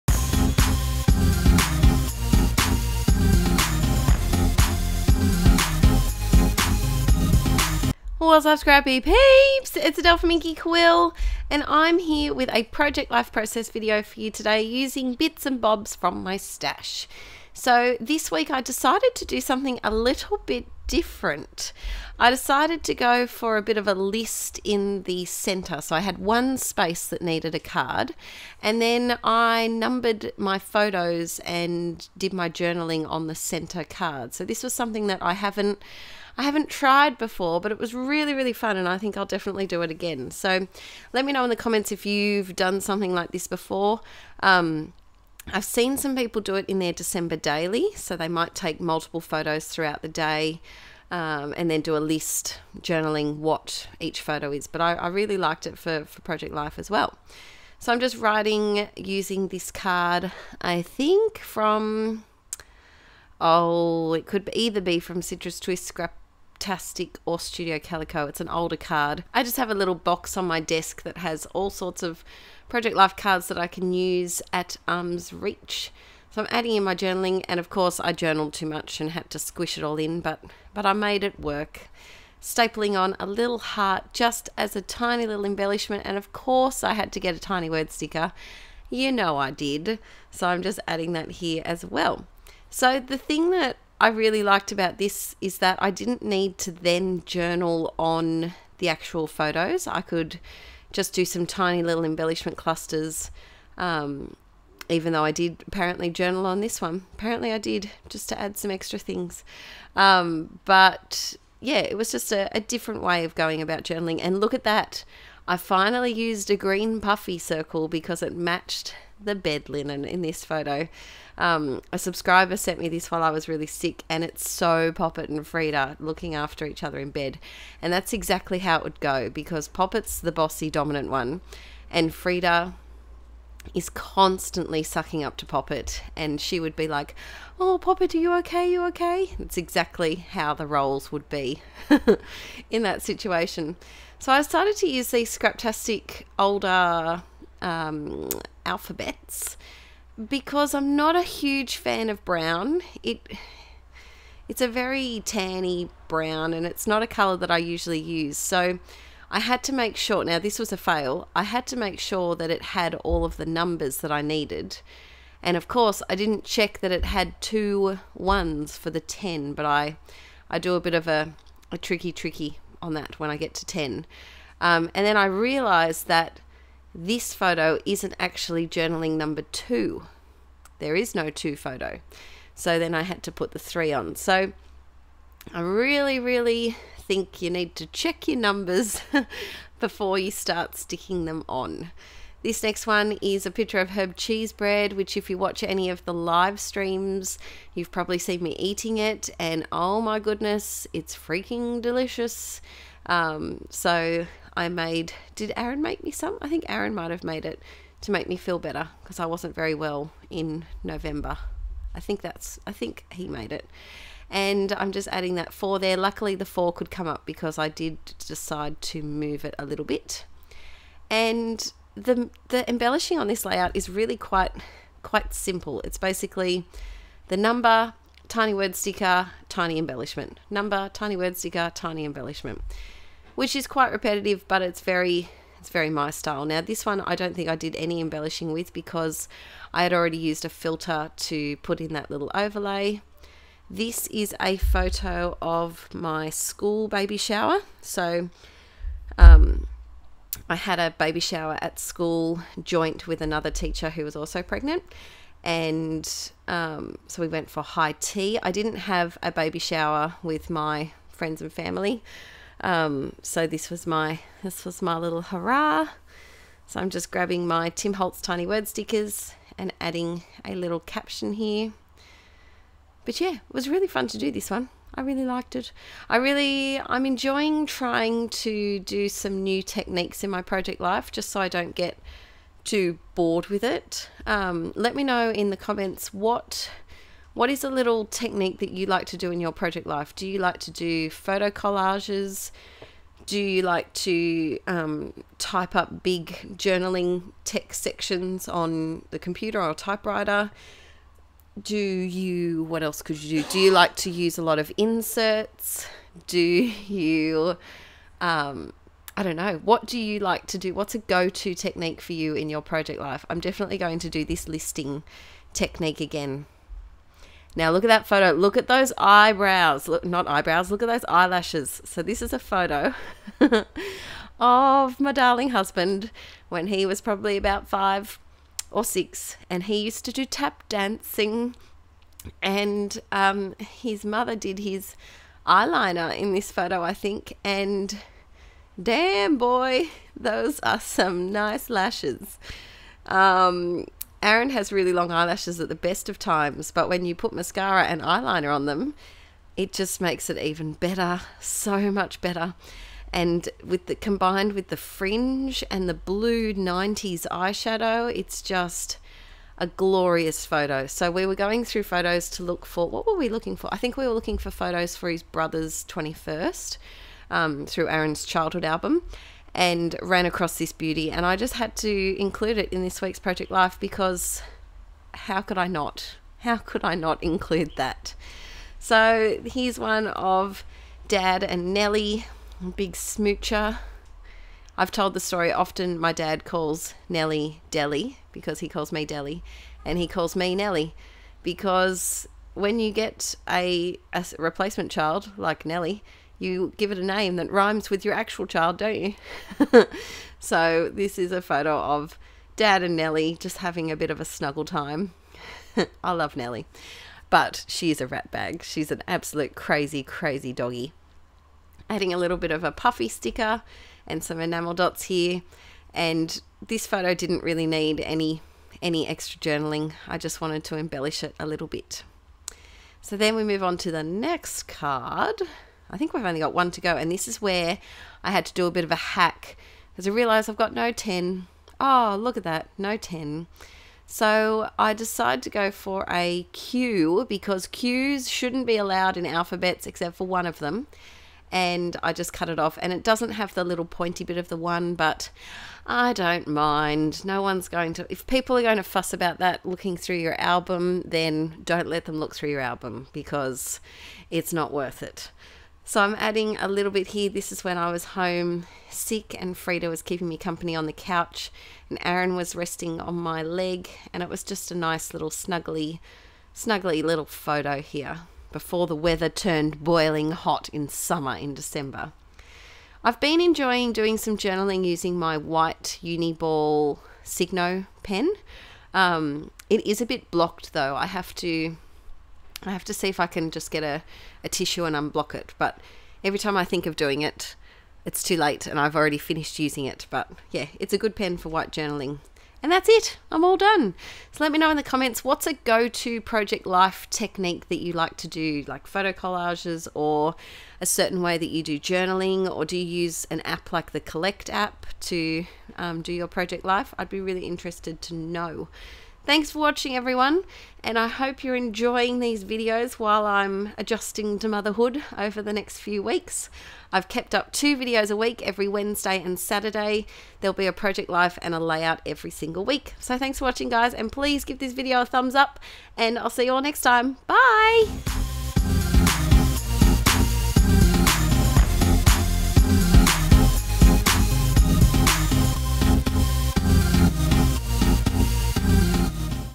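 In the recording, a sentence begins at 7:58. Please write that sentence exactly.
Um, it is a bit blocked though.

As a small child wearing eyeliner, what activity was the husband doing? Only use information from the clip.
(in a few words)
tap dancing.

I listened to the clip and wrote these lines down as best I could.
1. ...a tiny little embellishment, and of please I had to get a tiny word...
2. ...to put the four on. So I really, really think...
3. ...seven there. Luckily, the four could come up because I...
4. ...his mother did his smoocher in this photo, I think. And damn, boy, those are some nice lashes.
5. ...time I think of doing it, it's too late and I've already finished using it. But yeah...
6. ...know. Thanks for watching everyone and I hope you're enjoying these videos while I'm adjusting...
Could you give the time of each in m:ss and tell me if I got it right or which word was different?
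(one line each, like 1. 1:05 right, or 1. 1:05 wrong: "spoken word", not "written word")
1. 1:24 wrong: "course", not "please"
2. 3:03 wrong: "three", not "four"
3. 3:35 wrong: "four", not "seven"
4. 5:33 wrong: "eyeliner", not "smoocher"
5. 8:06 right
6. 8:28 right.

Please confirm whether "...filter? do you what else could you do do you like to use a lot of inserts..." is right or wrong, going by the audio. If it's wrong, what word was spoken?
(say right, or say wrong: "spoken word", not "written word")
wrong: "typewriter", not "filter".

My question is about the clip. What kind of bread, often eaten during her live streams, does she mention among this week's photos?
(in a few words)
herb cheese bread.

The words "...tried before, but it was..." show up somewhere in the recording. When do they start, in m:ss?
0:36.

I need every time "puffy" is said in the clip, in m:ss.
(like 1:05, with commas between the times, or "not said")
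1:57, 6:52.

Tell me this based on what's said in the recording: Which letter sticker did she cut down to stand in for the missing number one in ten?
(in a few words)
Q.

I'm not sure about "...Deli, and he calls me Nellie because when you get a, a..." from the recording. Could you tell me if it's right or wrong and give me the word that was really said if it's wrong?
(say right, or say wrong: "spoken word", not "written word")
right.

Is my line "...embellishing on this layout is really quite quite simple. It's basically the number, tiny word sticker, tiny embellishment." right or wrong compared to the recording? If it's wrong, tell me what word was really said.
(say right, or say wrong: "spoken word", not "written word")
right.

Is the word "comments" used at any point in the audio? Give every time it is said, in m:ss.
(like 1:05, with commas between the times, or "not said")
0:41, 4:45, 8:14.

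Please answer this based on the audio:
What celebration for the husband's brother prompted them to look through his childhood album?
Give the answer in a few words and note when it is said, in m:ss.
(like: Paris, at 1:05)
21st, at 6:05.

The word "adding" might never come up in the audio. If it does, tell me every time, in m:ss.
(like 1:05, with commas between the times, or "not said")
1:16, 1:30, 3:35, 4:29, 6:51, 7:36.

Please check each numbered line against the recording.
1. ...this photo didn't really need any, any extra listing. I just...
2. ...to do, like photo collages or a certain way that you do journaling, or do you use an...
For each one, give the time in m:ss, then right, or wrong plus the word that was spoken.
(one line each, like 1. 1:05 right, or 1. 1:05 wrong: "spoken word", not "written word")
1. 6:56 wrong: "journaling", not "listing"
2. 8:18 right.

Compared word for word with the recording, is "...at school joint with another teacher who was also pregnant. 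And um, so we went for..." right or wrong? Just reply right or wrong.
right.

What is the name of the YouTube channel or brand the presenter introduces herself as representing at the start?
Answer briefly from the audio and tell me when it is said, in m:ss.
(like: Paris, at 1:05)
Inkie Quill, at 0:10.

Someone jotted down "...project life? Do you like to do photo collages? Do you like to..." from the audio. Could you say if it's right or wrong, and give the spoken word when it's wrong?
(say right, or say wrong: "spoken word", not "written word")
right.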